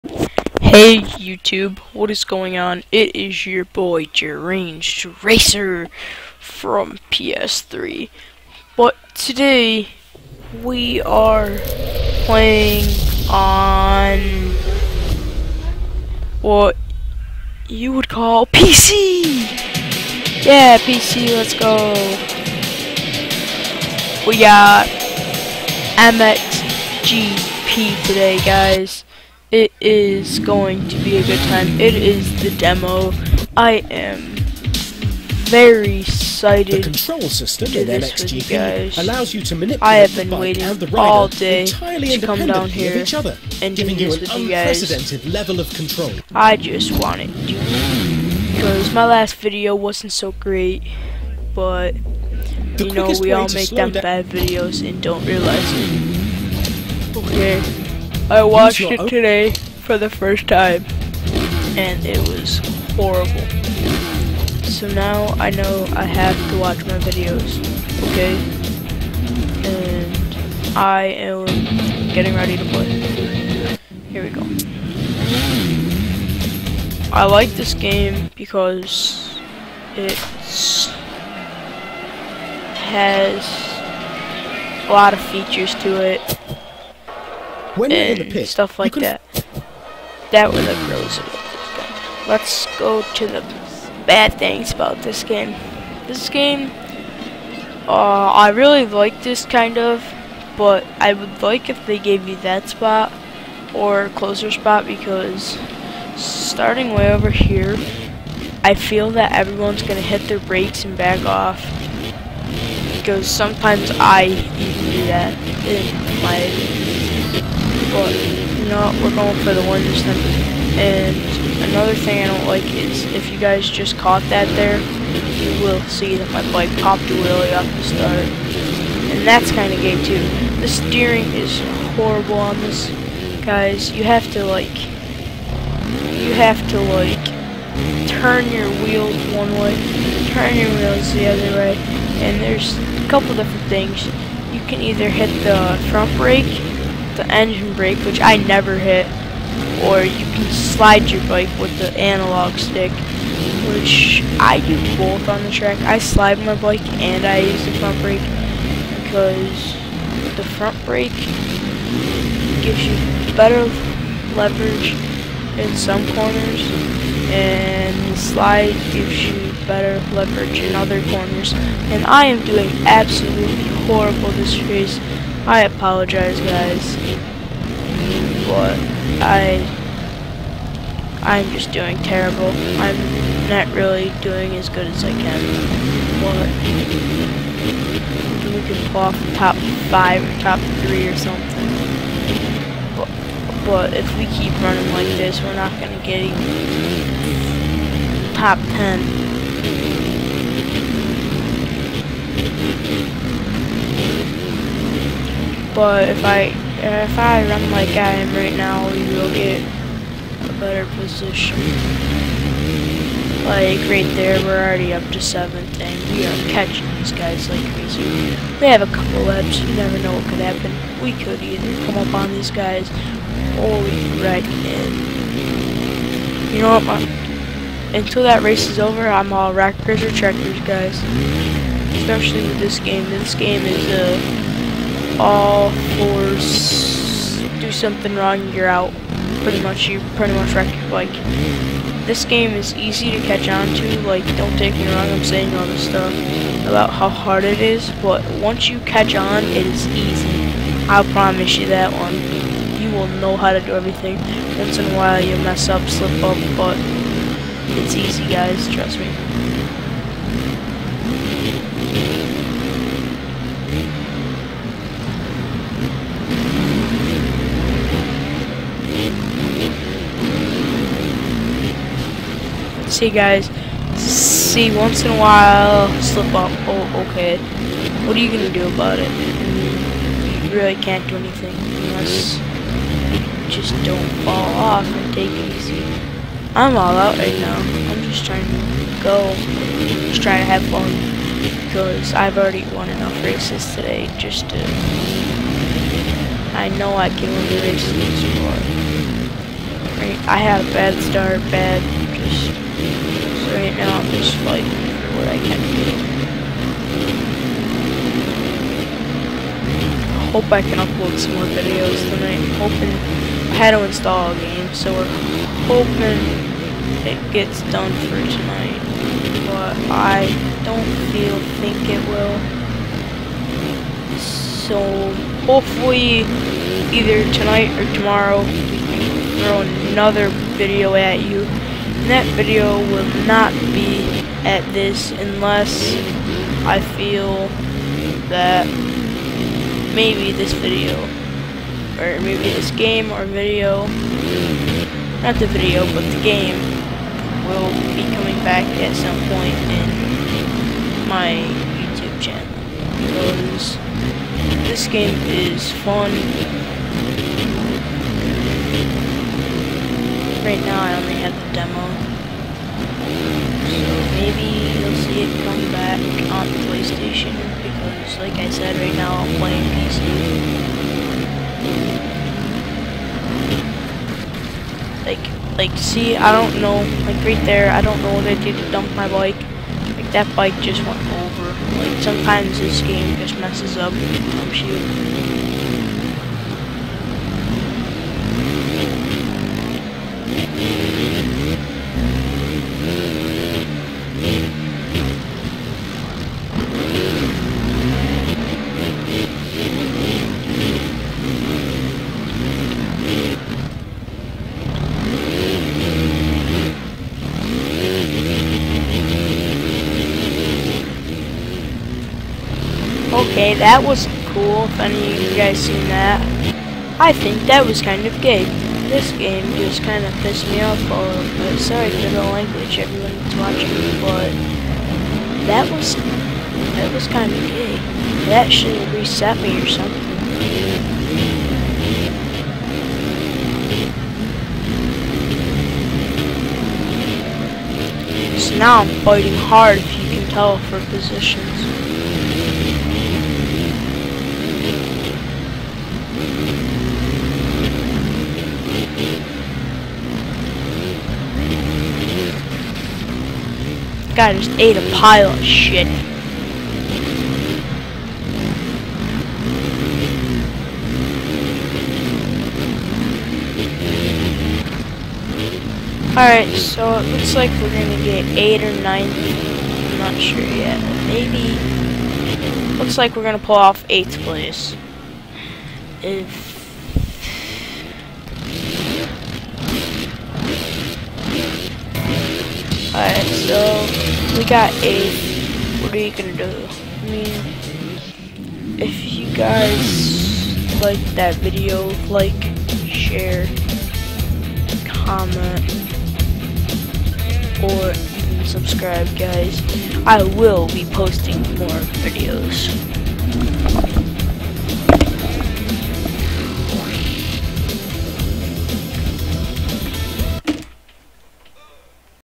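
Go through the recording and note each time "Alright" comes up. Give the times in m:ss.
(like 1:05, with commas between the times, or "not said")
7:46, 8:02.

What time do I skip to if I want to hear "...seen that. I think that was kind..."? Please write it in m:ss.
6:55.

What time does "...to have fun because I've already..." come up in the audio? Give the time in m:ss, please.
4:50.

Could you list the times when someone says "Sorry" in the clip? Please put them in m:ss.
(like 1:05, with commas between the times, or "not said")
7:01.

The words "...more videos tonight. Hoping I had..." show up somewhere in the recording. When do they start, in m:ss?
5:11.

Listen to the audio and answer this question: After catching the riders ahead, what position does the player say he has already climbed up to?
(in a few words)
7th.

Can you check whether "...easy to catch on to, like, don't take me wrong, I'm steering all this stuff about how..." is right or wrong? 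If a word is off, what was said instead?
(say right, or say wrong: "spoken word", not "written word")
wrong: "saying", not "steering".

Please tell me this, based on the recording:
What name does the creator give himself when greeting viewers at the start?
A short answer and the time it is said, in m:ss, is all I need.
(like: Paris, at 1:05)
Jerange Racer, at 0:04.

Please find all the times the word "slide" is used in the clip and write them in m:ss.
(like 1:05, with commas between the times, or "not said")
2:30, 2:35, 2:48.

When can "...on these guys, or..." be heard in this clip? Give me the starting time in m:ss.
3:42.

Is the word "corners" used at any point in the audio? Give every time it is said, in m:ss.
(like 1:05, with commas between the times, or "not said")
2:46, 2:51.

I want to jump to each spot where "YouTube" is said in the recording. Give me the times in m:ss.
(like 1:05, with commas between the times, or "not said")
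0:00, 5:51.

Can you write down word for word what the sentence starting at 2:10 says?
The steering is horrible on this, guys.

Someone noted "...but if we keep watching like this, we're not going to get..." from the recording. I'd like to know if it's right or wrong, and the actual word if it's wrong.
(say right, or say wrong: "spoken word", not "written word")
wrong: "running", not "watching".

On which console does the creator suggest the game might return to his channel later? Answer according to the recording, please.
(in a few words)
PlayStation.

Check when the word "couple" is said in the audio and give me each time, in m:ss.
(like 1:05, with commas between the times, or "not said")
2:23, 3:38.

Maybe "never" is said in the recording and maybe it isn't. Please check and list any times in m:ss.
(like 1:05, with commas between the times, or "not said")
2:28, 3:39.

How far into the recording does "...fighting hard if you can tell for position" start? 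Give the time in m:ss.
7:19.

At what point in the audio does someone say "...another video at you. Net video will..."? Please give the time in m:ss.
5:29.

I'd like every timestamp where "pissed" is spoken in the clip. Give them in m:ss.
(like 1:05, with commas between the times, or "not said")
7:00.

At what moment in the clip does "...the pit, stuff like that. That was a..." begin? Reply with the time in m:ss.
1:28.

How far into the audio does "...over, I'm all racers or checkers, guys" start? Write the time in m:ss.
3:48.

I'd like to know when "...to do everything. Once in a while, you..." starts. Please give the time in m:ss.
4:13.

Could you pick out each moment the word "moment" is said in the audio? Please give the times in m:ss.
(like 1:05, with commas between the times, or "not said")
not said.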